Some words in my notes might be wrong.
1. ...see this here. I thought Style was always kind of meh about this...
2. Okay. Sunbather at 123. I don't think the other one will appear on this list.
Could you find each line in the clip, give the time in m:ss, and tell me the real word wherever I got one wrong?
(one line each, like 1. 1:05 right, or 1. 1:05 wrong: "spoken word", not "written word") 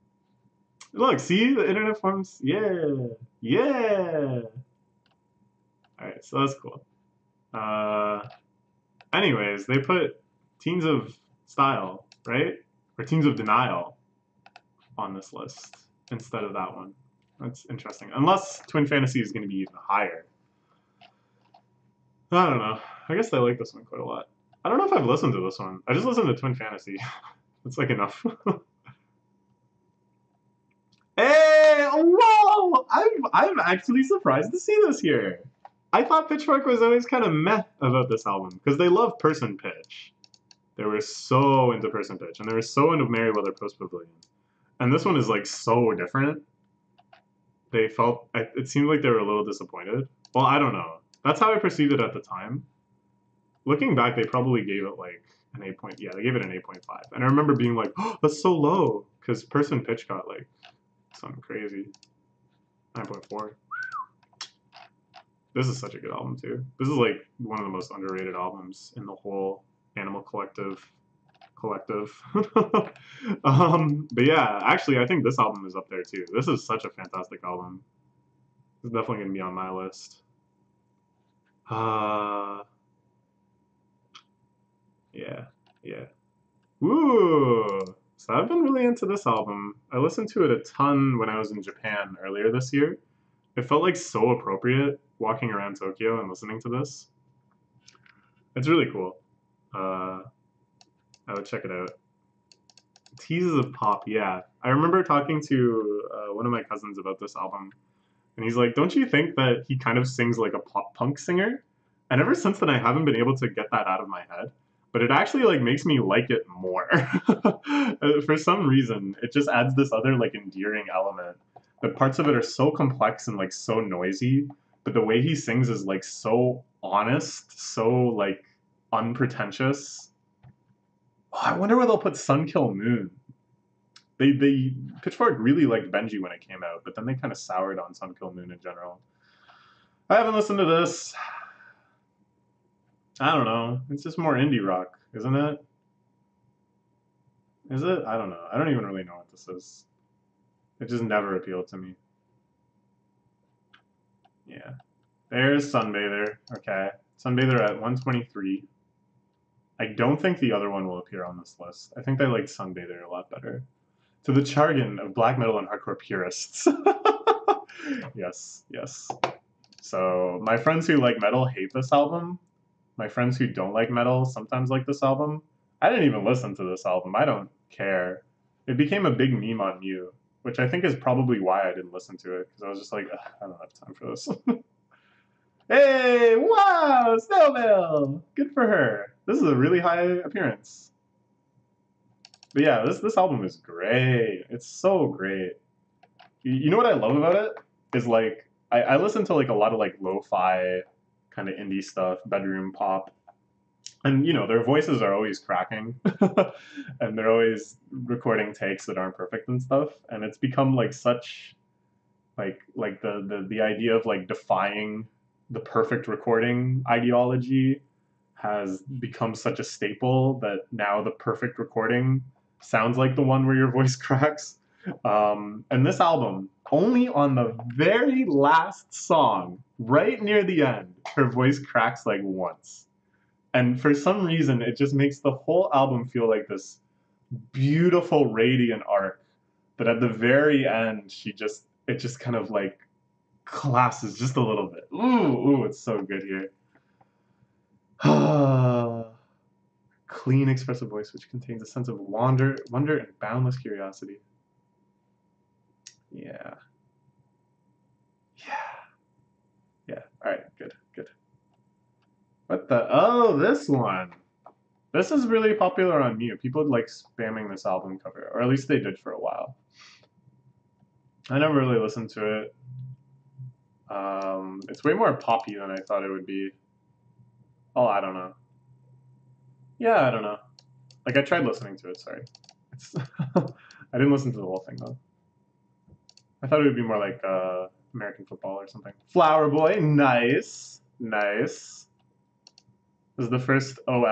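1. 0:34 wrong: "Pitchfork", not "Style"
2. 2:36 right.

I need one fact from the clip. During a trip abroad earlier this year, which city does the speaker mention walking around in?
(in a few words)
Tokyo.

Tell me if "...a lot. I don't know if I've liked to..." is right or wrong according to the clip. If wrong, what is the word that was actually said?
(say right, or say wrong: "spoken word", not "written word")
wrong: "listened", not "liked".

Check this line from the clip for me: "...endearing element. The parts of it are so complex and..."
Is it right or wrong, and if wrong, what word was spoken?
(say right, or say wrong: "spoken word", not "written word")
right.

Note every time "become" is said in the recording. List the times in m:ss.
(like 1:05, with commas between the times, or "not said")
3:30, 3:38.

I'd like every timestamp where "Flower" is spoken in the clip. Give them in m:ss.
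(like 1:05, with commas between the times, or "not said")
4:49.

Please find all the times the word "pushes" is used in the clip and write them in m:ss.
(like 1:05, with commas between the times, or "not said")
not said.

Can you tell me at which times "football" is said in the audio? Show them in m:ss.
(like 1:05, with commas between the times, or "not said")
4:48.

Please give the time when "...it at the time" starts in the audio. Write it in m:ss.
0:51.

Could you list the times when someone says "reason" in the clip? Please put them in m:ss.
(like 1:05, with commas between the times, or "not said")
1:58, 3:54.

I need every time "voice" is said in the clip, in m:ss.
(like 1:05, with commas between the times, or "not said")
3:24, 3:43, 3:51, 4:10.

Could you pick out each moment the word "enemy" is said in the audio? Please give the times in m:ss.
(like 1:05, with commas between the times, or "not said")
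not said.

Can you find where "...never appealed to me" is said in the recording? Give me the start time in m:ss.
2:31.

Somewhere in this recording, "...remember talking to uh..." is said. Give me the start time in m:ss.
1:44.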